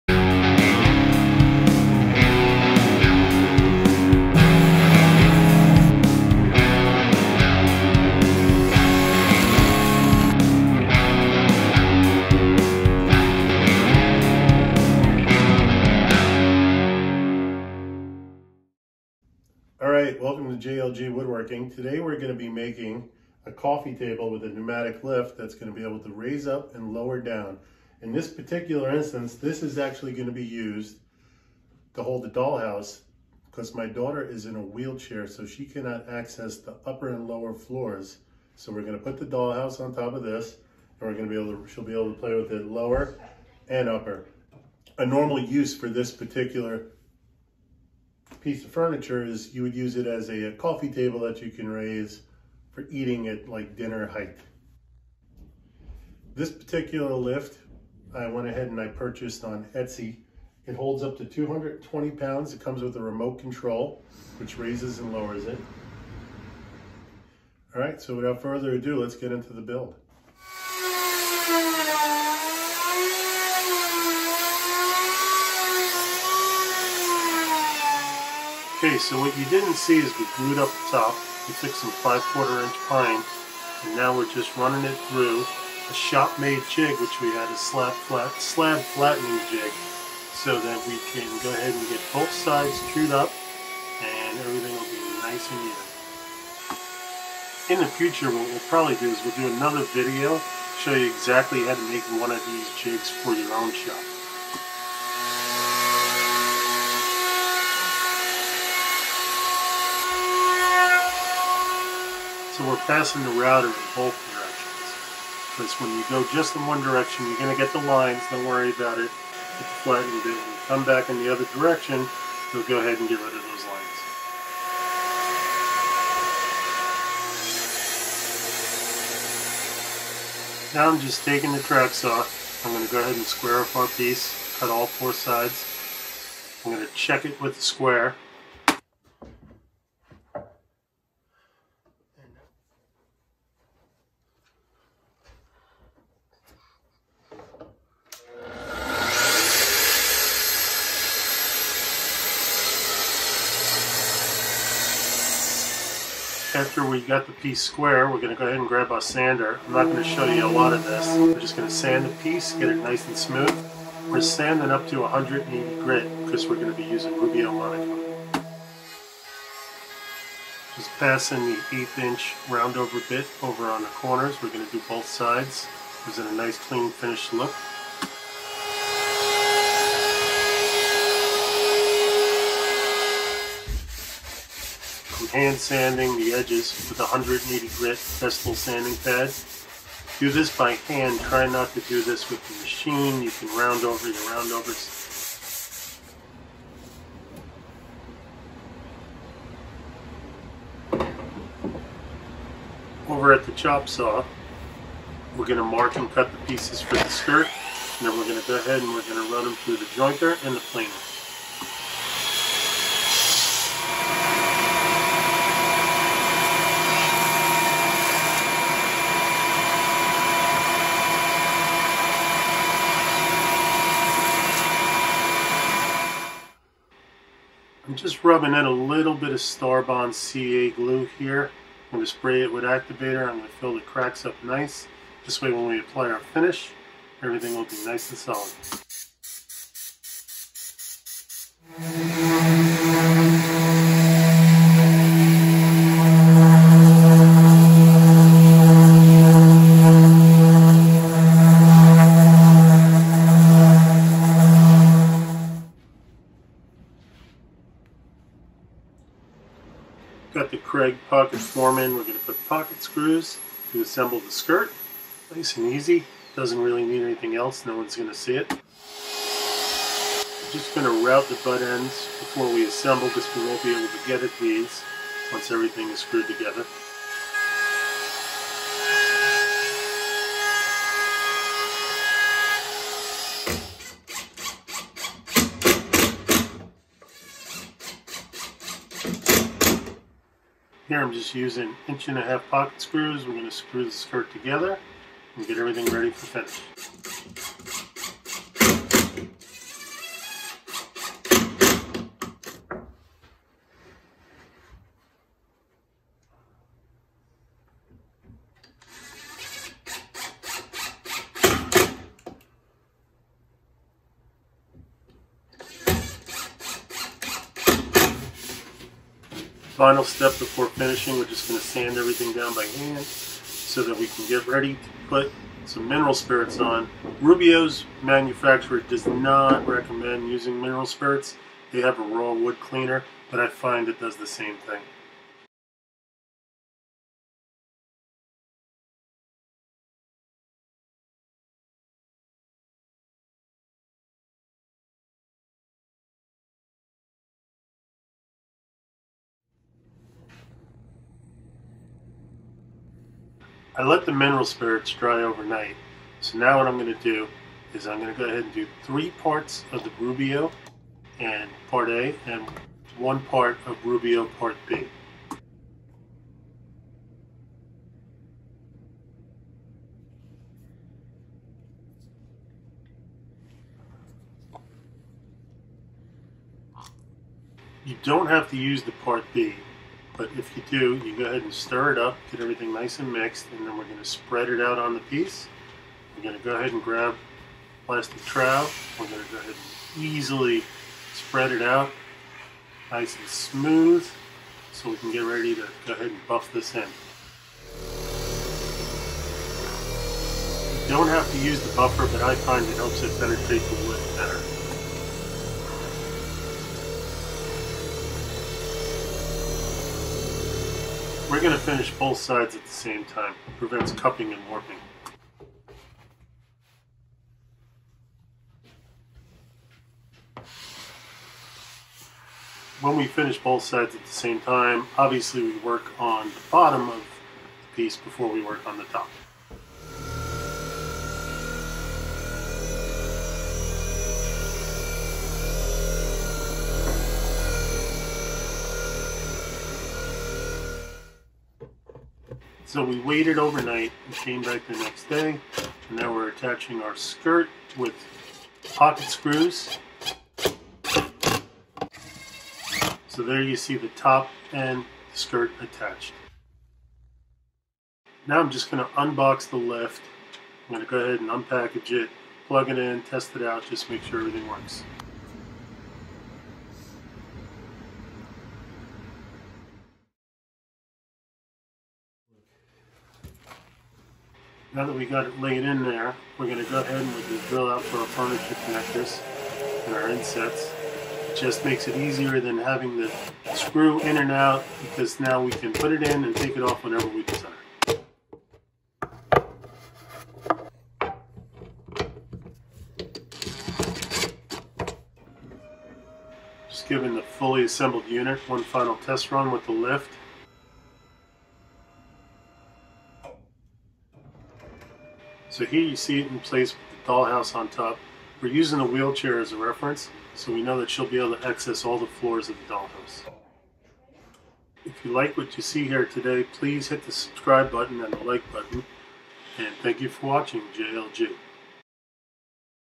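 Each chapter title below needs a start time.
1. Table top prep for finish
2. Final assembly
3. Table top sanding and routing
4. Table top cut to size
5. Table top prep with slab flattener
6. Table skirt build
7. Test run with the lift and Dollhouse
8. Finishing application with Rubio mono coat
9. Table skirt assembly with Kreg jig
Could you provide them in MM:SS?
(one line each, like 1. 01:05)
1. 03:50
2. 07:25
3. 02:40
4. 02:10
5. 01:10
6. 03:15
7. 08:15
8. 05:30
9. 04:15.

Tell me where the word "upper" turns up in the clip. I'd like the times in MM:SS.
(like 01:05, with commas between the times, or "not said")
00:36, 00:43.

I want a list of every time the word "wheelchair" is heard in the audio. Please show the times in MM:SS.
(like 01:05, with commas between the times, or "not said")
00:34, 08:28.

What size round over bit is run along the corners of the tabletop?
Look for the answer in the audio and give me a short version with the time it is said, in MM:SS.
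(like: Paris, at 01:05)
eighth inch, at 02:51.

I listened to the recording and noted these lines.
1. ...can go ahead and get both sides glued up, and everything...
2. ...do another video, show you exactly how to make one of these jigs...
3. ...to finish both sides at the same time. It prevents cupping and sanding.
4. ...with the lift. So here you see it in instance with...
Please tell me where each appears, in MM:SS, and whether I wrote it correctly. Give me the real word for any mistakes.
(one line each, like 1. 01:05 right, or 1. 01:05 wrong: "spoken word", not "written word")
1. 01:31 right
2. 01:39 right
3. 06:51 wrong: "warping", not "sanding"
4. 08:19 wrong: "place", not "instance".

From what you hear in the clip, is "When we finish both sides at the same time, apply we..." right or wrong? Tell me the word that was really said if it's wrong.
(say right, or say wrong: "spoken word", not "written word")
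wrong: "obviously", not "apply".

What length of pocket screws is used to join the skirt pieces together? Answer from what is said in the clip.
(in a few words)
inch and a half.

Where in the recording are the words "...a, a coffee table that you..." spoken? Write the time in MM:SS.
00:50.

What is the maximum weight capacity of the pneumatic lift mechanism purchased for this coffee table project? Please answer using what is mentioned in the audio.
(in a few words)
220 pounds.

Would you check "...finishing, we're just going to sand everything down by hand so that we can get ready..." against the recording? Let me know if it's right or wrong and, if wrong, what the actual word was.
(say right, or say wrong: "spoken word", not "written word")
right.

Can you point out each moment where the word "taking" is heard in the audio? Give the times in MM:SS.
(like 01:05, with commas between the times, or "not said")
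02:11.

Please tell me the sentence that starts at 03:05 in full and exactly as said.
hand sanding the edges with a 180 grit Festool sanding pad.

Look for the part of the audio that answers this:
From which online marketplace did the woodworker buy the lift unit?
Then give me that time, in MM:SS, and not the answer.
00:59.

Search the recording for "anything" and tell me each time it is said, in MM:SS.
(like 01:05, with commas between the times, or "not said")
04:27.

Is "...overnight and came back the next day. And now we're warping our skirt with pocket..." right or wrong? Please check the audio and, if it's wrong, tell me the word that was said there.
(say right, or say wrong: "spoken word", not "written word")
wrong: "attaching", not "warping".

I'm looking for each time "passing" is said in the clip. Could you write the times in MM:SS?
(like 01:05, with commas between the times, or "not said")
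01:52, 02:50.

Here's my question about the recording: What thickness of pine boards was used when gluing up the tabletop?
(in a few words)
5 quarter inch.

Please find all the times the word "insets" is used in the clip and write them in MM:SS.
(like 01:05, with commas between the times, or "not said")
08:00.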